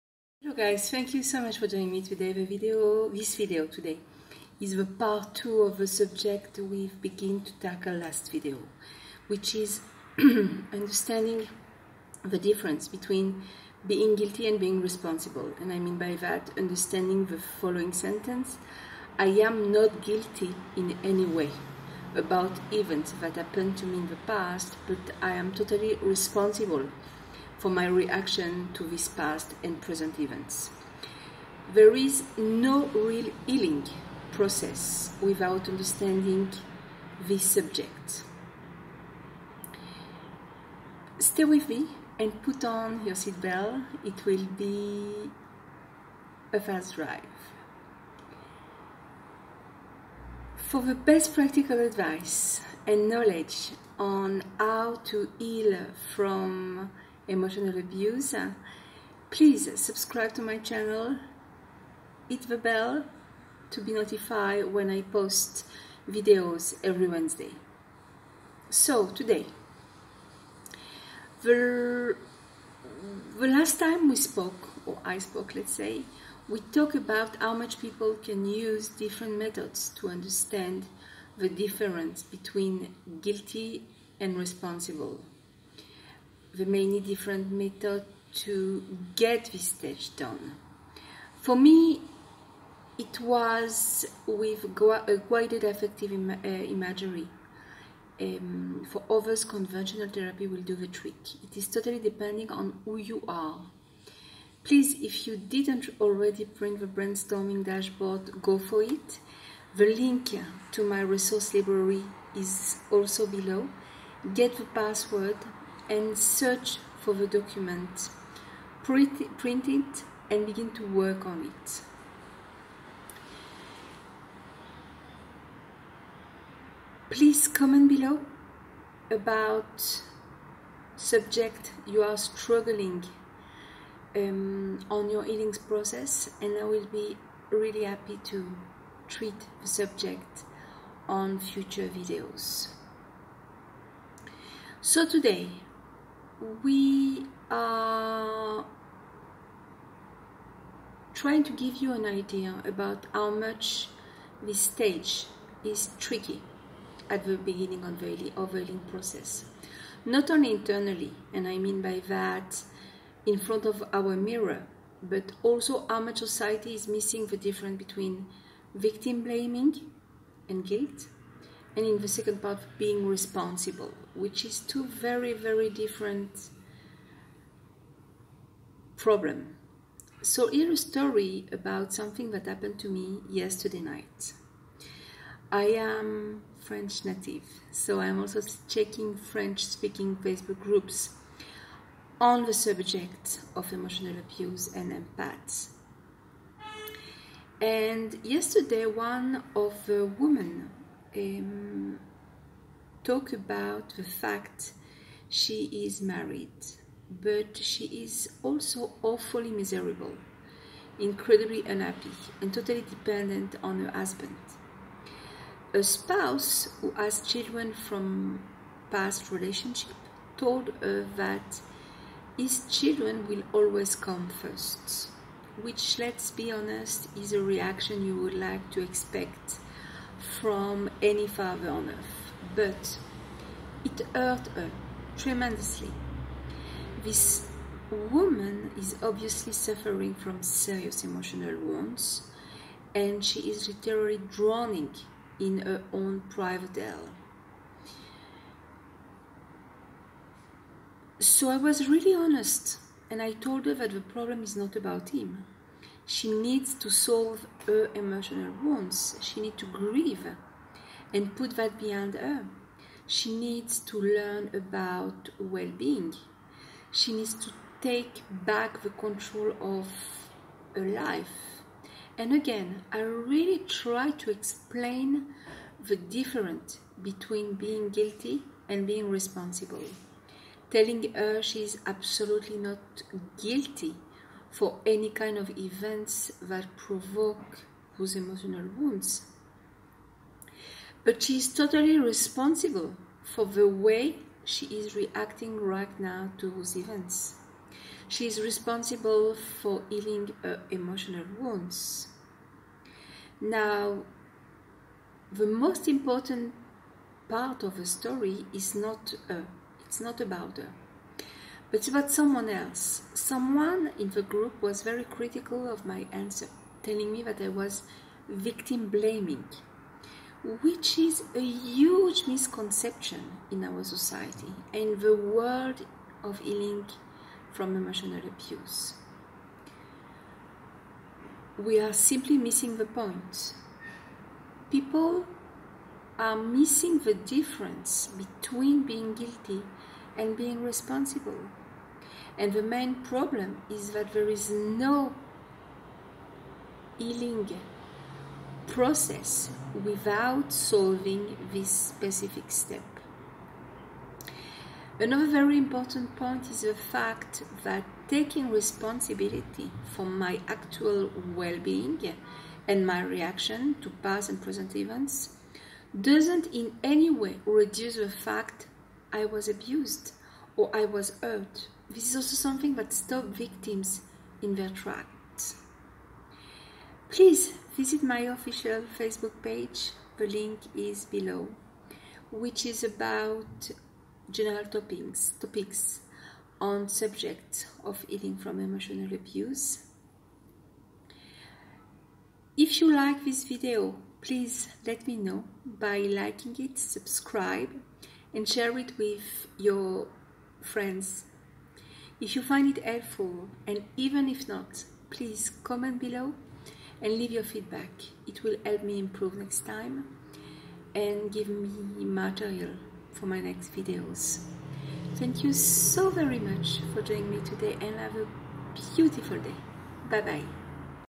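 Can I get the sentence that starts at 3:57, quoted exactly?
This woman is obviously suffering from serious emotional wounds and she is literally drowning in her own private hell.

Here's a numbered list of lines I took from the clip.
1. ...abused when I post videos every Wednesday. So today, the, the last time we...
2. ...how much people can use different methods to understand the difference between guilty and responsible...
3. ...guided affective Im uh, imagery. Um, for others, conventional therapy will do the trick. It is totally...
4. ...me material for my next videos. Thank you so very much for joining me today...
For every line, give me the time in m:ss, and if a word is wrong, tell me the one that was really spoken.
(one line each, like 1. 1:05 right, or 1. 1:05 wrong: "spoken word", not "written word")
1. 1:03 wrong: "notified", not "abused"
2. 1:17 right
3. 1:35 right
4. 6:51 right.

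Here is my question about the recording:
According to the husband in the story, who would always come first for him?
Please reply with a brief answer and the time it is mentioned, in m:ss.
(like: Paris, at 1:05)
his children, at 3:42.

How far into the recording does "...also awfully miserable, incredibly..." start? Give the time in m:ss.
3:28.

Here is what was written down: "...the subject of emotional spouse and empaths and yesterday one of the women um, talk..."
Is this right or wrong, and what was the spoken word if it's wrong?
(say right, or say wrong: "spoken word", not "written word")
wrong: "abuse", not "spouse".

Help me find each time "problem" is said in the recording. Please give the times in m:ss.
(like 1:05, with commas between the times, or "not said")
2:58, 4:14, 5:42.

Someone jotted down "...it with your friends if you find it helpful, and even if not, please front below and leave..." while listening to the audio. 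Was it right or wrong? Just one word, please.
wrong.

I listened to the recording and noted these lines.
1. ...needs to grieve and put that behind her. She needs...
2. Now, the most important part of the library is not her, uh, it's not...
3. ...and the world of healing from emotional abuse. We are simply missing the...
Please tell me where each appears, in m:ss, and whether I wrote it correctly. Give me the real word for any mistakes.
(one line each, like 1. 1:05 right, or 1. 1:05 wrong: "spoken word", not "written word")
1. 4:19 right
2. 5:03 wrong: "story", not "library"
3. 5:24 right.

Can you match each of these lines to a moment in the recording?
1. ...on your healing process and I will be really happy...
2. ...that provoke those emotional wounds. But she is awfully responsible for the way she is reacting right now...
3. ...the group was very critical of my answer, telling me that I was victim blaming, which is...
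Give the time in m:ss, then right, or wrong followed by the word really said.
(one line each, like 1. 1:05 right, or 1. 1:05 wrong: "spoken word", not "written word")
1. 2:14 right
2. 4:46 wrong: "totally", not "awfully"
3. 5:14 right.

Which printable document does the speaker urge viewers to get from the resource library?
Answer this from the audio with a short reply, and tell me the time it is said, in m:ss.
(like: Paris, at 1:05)
brainstorming dashboard, at 1:46.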